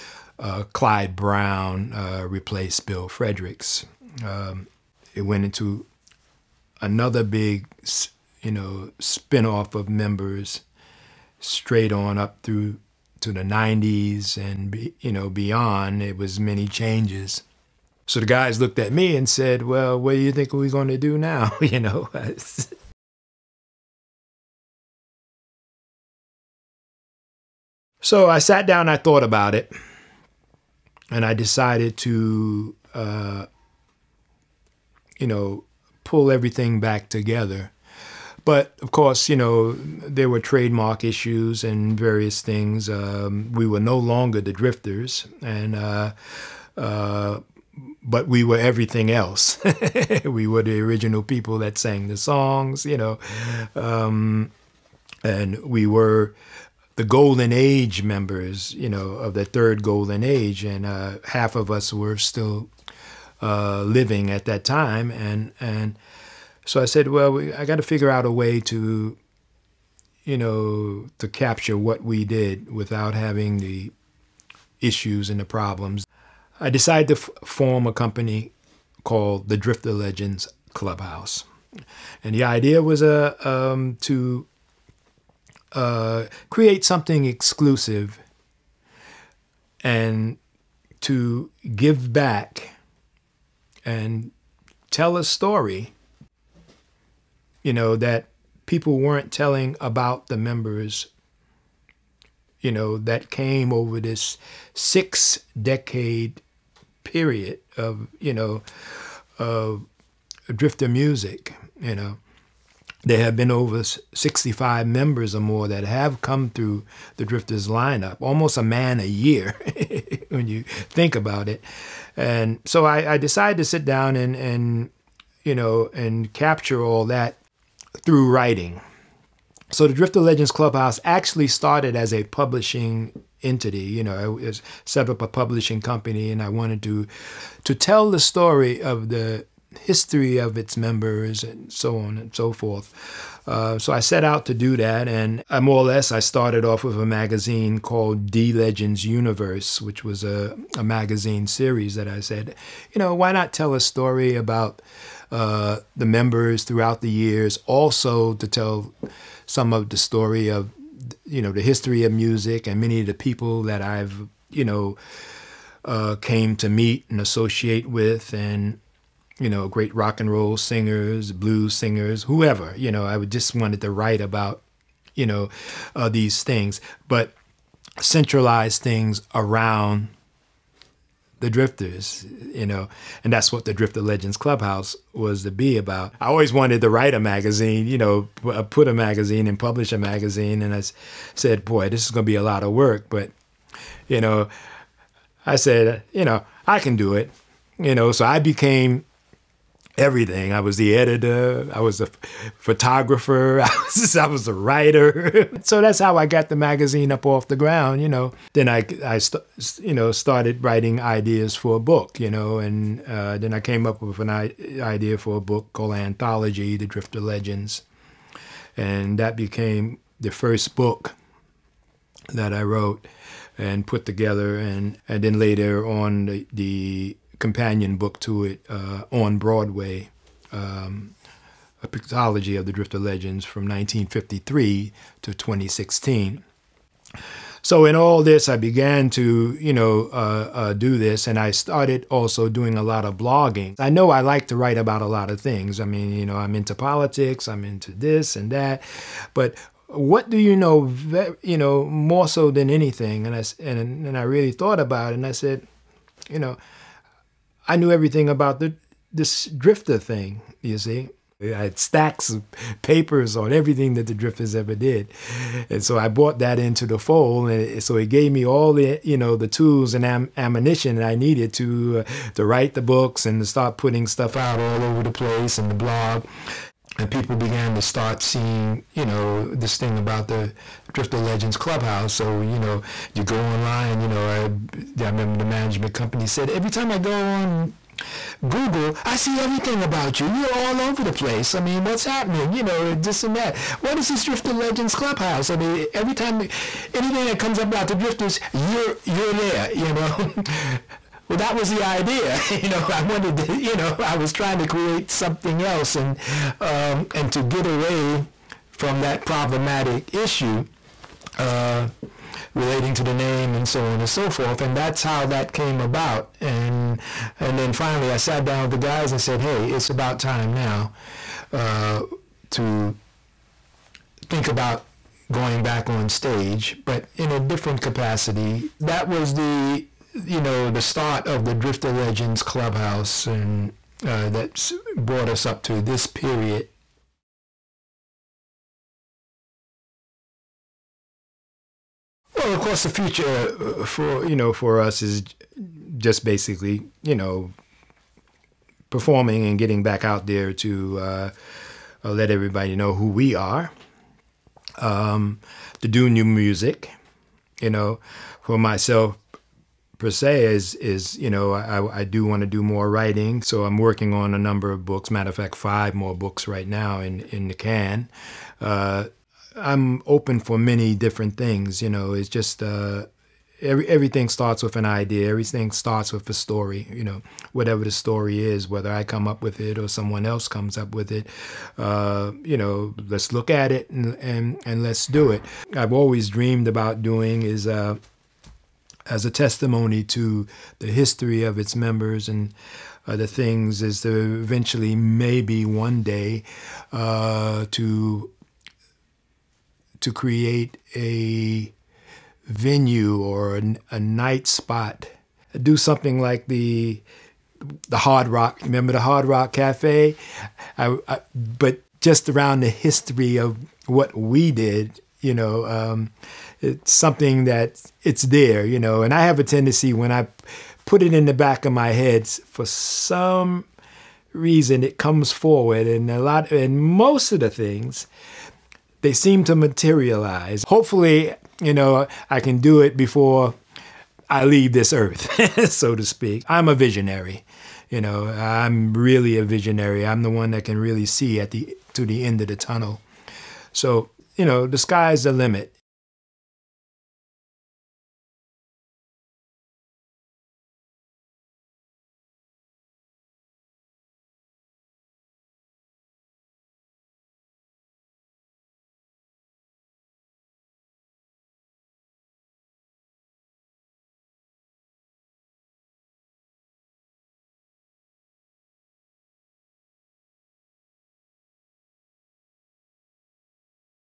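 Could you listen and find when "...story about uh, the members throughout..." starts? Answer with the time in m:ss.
2:33.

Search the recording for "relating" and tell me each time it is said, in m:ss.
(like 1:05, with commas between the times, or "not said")
5:12.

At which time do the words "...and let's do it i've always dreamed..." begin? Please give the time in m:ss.
6:24.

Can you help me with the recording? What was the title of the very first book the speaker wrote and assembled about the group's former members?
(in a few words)
Anthology, The Drifter Legends.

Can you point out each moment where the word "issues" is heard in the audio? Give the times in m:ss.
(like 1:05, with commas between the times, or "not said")
0:41, 1:14, 5:10.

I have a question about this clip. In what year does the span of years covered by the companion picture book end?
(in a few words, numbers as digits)
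2016.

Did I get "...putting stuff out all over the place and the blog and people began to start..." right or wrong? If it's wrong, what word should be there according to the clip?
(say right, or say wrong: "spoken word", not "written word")
right.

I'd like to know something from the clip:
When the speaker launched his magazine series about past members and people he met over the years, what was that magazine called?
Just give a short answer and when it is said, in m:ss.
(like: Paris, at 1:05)
D Legends Universe, at 2:28.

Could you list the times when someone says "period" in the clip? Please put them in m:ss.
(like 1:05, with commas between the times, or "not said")
1:47, 5:36.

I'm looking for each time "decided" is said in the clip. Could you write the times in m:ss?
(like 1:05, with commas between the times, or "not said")
0:31, 1:16, 2:03.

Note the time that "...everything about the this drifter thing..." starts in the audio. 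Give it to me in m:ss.
4:17.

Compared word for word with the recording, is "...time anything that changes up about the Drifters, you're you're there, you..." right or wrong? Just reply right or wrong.
wrong.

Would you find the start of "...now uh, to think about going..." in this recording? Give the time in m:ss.
5:20.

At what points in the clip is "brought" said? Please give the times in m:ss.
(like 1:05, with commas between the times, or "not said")
4:26, 5:34.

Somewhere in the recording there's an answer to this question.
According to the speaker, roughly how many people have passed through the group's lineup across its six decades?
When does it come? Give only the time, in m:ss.
1:53.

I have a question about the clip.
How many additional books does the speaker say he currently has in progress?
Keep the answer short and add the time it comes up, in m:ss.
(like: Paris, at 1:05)
5, at 6:05.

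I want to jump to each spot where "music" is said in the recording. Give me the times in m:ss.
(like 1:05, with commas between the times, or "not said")
1:50, 2:42, 5:56.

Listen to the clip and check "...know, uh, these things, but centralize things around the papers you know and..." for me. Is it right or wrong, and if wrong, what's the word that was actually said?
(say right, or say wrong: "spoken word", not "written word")
wrong: "drifters", not "papers".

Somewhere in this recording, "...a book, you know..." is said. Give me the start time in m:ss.
3:31.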